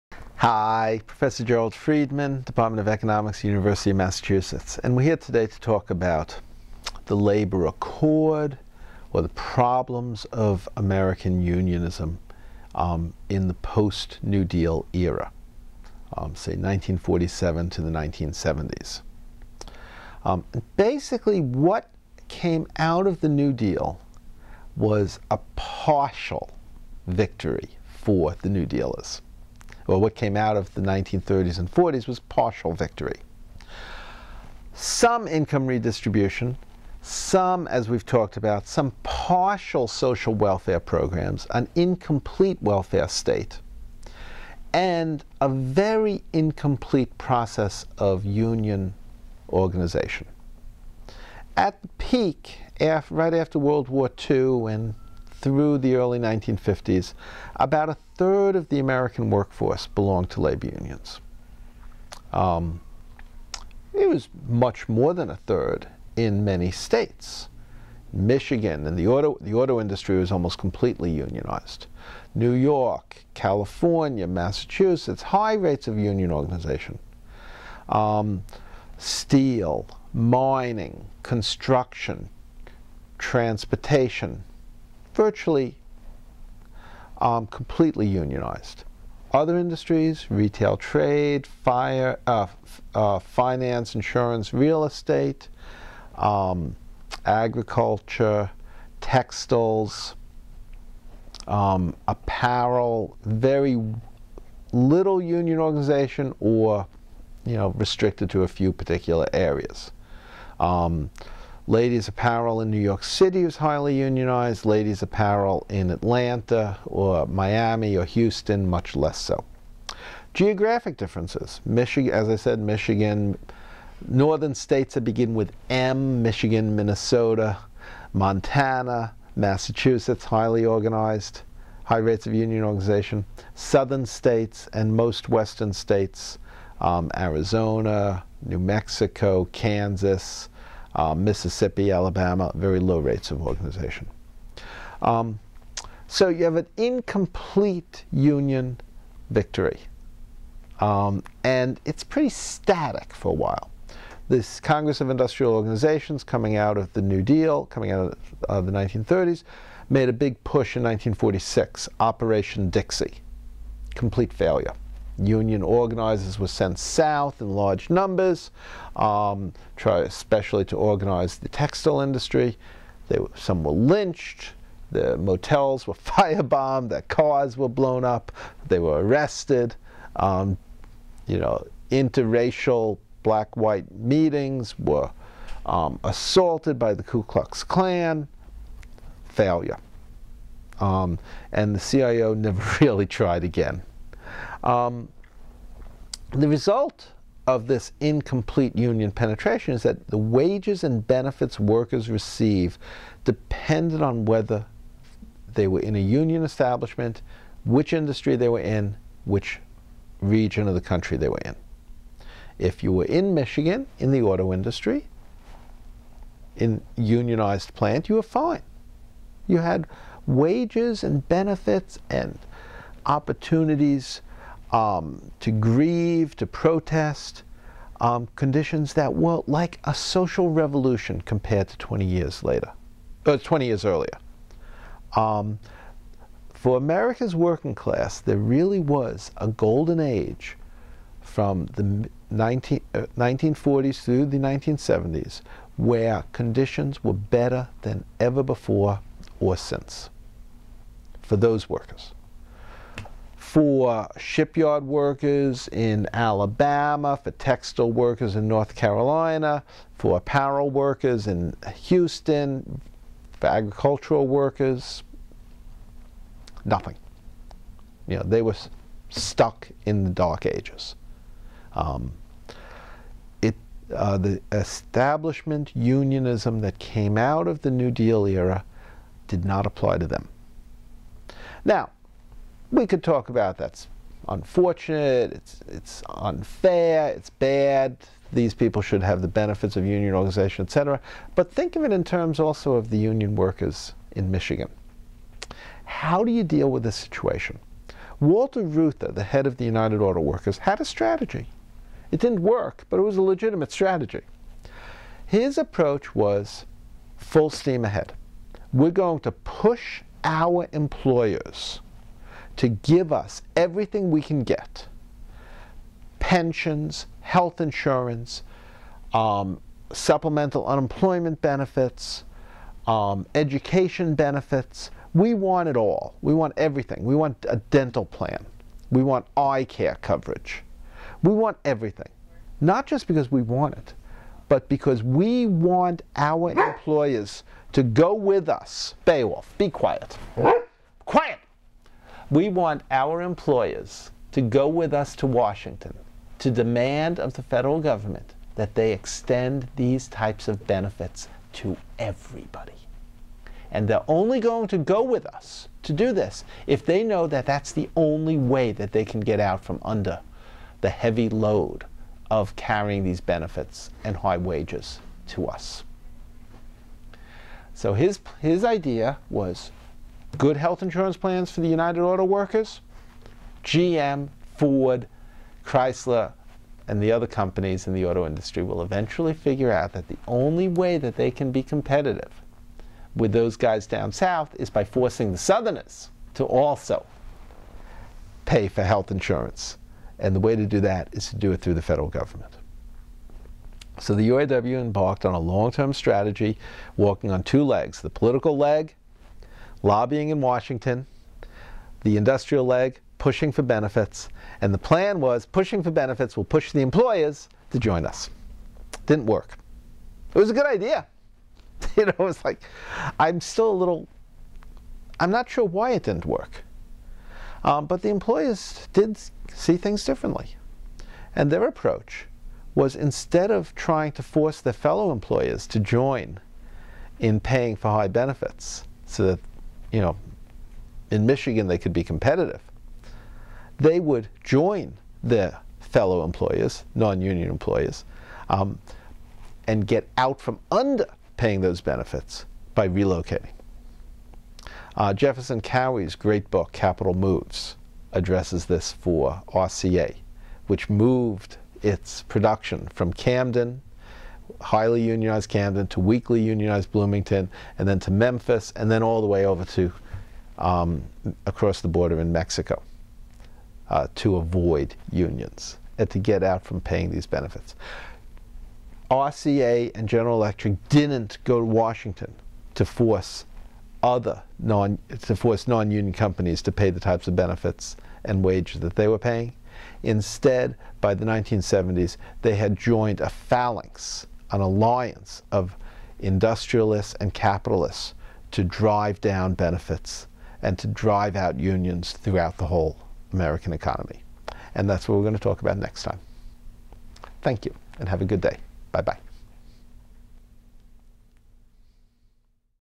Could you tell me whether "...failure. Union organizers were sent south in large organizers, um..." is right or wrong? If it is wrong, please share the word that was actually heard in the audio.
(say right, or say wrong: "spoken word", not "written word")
wrong: "numbers", not "organizers".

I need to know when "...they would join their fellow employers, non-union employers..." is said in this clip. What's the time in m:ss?
7:13.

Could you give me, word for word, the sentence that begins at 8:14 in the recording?
And that's what we're going to talk about next time.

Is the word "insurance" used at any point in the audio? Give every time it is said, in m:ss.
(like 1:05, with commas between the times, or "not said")
1:33, 5:17, 6:10, 6:29.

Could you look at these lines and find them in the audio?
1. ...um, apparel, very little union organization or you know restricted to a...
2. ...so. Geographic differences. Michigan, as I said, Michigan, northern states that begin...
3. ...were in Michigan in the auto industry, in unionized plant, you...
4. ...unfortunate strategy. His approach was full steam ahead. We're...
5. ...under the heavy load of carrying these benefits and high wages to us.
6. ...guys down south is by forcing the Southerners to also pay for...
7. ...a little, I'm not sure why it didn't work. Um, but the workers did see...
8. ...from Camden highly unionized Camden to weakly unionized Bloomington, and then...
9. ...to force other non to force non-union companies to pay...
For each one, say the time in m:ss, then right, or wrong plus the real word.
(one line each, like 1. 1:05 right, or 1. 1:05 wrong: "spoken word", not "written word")
1. 1:41 right
2. 1:59 right
3. 3:32 right
4. 5:03 wrong: "legitimate", not "unfortunate"
5. 5:59 right
6. 6:23 right
7. 6:53 wrong: "employers", not "workers"
8. 7:32 right
9. 7:52 right.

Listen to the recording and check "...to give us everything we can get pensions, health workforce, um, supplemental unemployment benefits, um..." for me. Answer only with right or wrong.
wrong.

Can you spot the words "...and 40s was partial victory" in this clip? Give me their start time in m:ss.
0:31.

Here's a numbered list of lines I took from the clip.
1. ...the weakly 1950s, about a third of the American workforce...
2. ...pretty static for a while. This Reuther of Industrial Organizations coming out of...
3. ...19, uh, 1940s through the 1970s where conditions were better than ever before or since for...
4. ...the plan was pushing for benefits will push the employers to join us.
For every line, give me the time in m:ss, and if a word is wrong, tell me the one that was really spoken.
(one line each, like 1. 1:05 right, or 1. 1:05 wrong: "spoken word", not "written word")
1. 0:55 wrong: "early", not "weakly"
2. 2:32 wrong: "Congress", not "Reuther"
3. 4:02 right
4. 6:44 right.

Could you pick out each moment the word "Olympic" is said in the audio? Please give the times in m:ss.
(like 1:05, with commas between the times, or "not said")
not said.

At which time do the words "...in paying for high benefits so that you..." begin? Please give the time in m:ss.
7:07.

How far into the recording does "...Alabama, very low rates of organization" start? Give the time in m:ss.
2:21.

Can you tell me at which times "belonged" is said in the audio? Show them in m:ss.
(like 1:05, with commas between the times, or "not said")
0:59.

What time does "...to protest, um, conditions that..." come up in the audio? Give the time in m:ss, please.
3:46.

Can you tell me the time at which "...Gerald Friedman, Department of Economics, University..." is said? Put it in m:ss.
0:01.